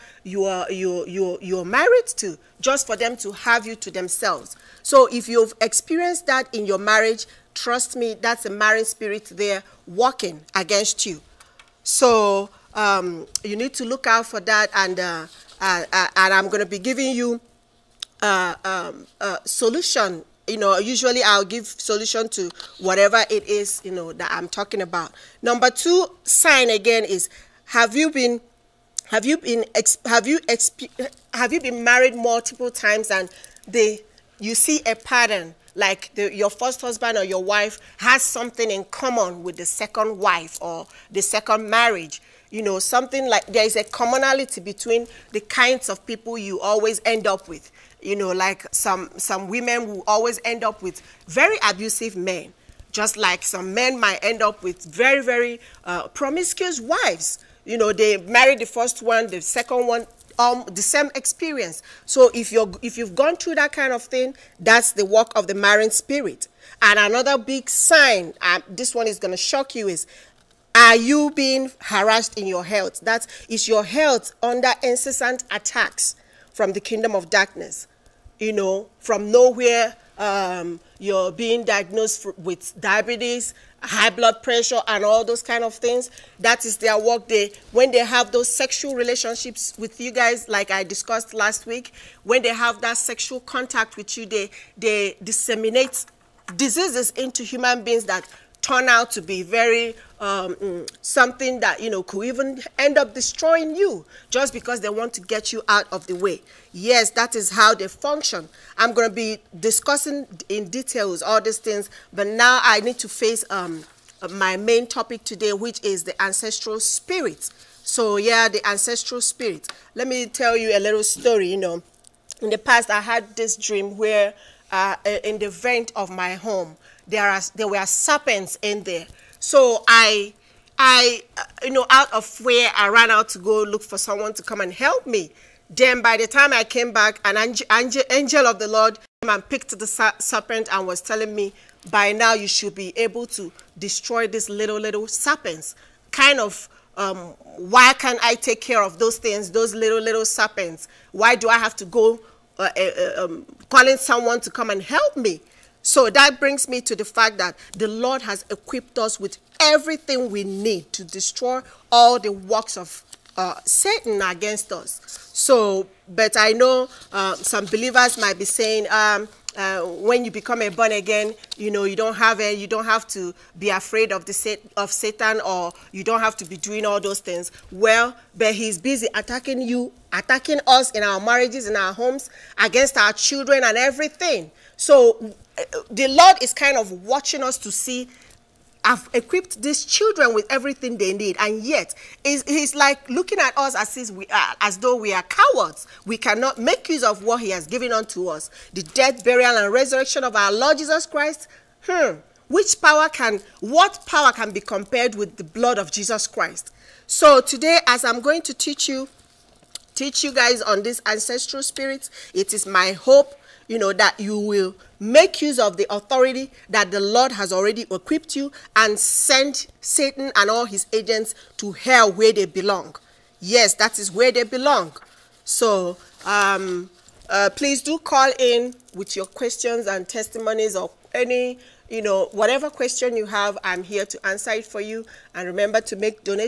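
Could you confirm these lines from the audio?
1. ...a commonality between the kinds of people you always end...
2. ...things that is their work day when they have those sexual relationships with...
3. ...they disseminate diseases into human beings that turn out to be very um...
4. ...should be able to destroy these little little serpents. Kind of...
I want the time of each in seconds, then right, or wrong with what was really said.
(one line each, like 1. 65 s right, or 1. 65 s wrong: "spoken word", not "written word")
1. 43 s right
2. 85 s right
3. 94 s right
4. 142 s right.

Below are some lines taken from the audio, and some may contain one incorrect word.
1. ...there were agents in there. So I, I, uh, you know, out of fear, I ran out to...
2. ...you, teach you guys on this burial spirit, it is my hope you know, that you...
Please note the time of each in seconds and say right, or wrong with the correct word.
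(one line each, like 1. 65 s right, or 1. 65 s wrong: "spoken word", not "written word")
1. 127 s wrong: "serpents", not "agents"
2. 208 s wrong: "ancestral", not "burial".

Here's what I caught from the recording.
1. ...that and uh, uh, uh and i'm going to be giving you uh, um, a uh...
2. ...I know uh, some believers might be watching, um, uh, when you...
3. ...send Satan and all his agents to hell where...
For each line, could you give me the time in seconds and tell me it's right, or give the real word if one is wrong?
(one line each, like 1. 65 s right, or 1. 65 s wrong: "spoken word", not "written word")
1. 14 s right
2. 166 s wrong: "saying", not "watching"
3. 218 s right.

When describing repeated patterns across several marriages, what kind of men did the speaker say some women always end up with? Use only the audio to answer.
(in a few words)
Abusive men.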